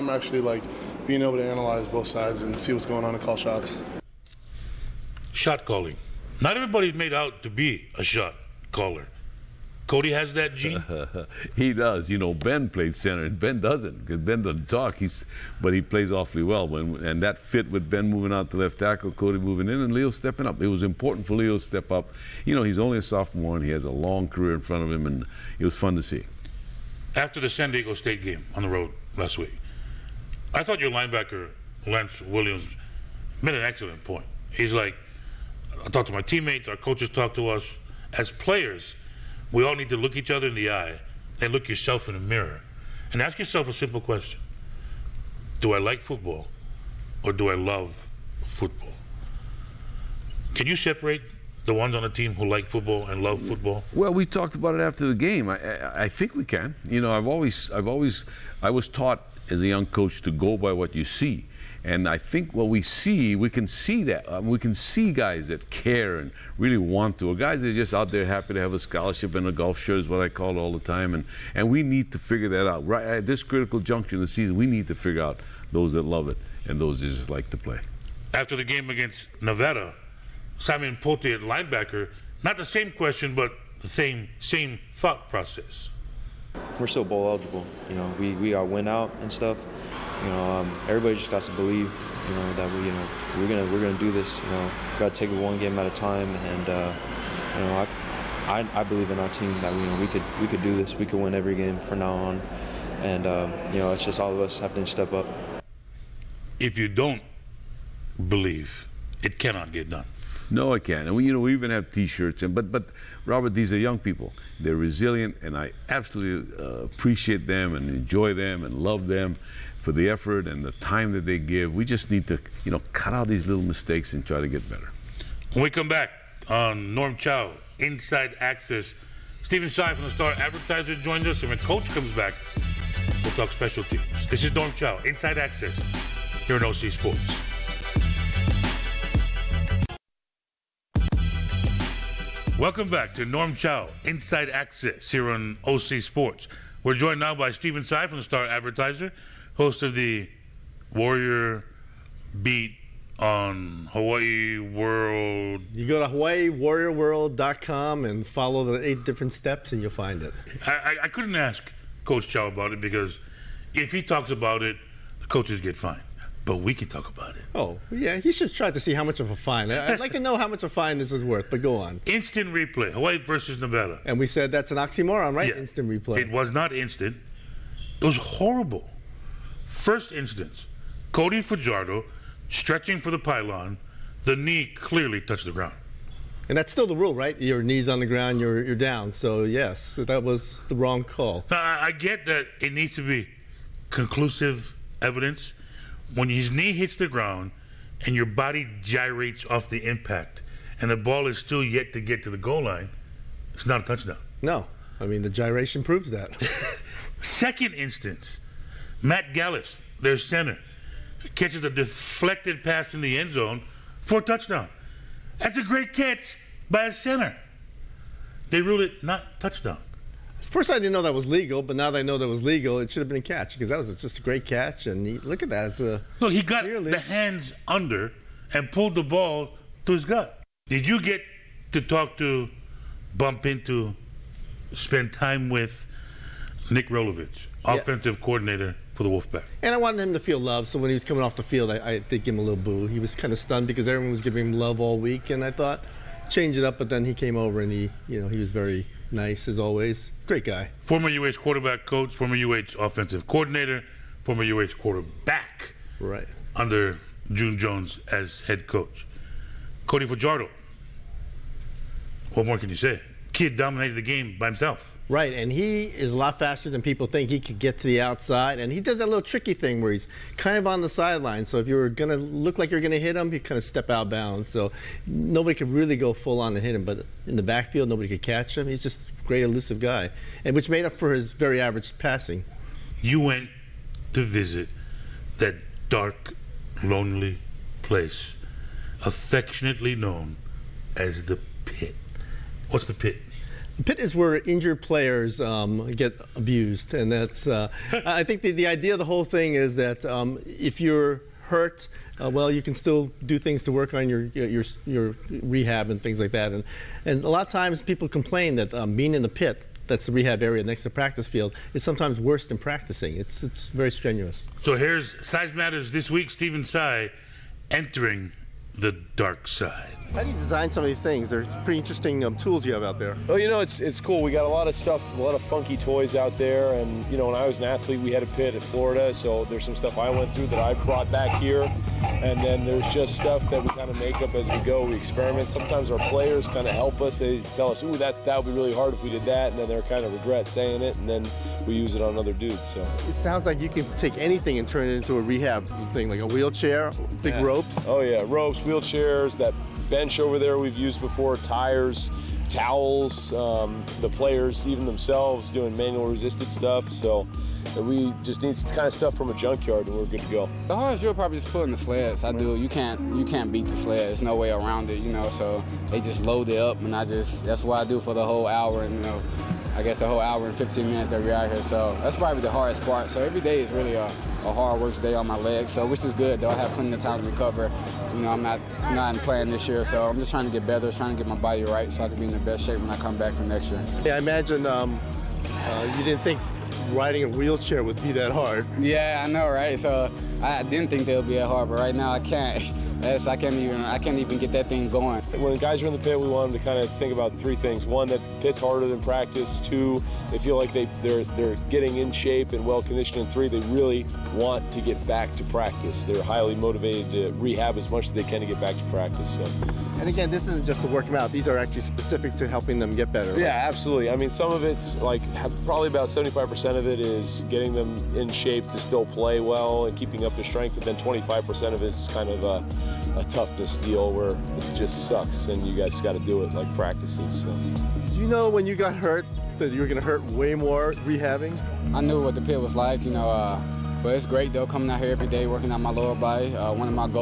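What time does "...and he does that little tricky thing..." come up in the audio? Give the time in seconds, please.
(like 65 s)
268 s.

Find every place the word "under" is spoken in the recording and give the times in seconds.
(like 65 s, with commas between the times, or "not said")
227 s, 256 s.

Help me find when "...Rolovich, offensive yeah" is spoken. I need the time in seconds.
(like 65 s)
236 s.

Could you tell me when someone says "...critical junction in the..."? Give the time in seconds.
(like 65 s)
73 s.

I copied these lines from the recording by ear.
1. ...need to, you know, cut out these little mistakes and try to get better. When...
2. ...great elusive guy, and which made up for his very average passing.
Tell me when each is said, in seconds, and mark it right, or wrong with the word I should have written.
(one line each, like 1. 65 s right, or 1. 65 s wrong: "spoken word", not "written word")
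1. 122 s right
2. 279 s right.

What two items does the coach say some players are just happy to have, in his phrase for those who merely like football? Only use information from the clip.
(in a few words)
a scholarship and a golf shirt.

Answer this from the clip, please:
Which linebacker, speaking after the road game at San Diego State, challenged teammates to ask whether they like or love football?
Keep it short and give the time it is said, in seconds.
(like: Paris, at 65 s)
Lance Williams, at 31 s.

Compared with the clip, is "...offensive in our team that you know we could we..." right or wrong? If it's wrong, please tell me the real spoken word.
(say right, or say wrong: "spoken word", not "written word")
wrong: "believe", not "offensive".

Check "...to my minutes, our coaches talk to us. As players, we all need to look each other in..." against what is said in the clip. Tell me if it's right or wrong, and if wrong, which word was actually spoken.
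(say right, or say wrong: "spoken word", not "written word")
wrong: "teammates", not "minutes".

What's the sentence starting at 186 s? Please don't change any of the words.
And that's still the rule, right?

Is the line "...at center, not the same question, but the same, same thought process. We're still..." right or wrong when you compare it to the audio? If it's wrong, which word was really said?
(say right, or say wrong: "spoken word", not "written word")
wrong: "linebacker", not "center".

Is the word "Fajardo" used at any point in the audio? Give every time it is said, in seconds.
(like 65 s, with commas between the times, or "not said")
181 s, 260 s.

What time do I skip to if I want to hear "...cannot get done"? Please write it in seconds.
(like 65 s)
109 s.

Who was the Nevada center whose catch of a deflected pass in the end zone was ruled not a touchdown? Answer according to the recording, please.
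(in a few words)
Matt Gallis.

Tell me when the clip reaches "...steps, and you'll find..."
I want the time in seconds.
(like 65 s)
159 s.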